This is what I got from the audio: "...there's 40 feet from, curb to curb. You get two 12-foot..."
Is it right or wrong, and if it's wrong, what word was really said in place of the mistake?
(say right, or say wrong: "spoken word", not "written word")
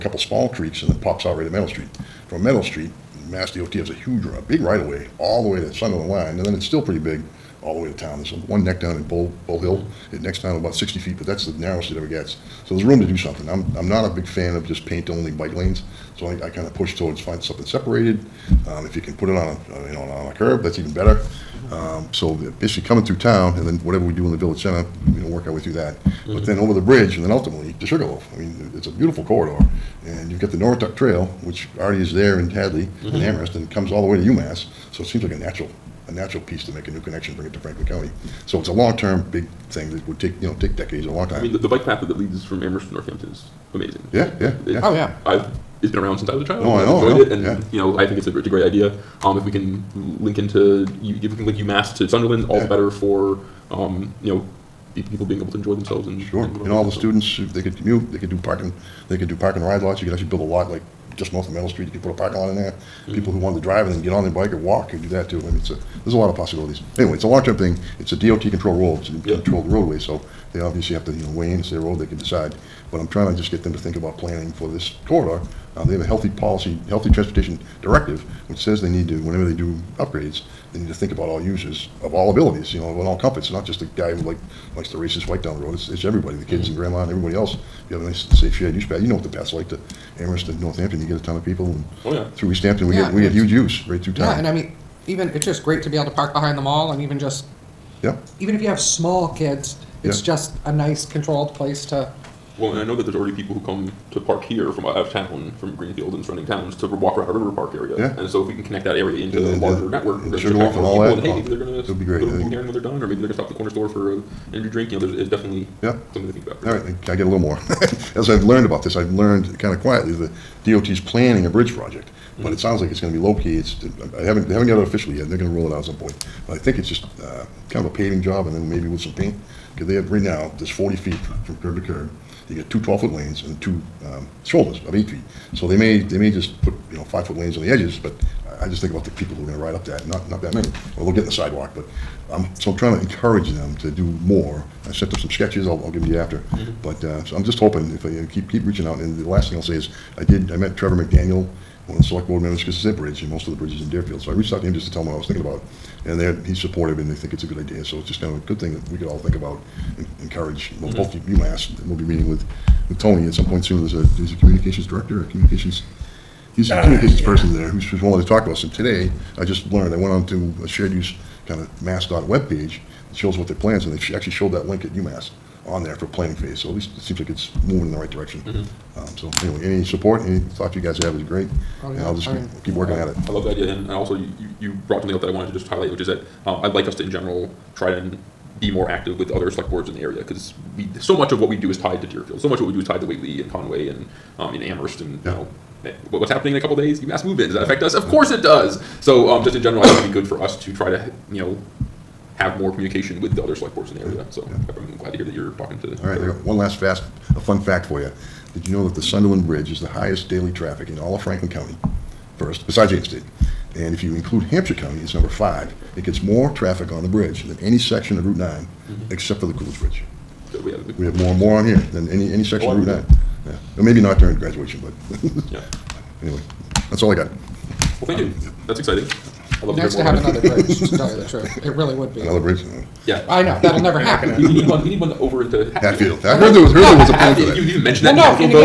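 right.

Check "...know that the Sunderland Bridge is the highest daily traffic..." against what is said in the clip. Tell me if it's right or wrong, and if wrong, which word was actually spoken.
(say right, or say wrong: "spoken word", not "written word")
right.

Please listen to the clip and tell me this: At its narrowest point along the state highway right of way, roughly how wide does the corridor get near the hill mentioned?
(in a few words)
60 feet.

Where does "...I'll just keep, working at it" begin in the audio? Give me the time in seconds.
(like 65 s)
182 s.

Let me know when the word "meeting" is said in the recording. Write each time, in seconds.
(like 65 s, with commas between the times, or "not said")
162 s.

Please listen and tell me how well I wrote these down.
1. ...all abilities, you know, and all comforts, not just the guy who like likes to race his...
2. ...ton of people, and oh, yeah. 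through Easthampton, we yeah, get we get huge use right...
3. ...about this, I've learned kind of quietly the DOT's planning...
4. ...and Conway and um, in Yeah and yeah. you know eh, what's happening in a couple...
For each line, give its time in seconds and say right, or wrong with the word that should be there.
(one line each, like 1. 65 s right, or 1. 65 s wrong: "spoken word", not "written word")
1. 82 s right
2. 91 s right
3. 118 s right
4. 193 s wrong: "Amherst", not "Yeah".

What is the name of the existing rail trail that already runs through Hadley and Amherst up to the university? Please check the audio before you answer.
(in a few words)
Norwottuck Trail.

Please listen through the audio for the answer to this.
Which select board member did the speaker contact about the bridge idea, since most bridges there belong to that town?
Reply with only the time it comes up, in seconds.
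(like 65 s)
150 s.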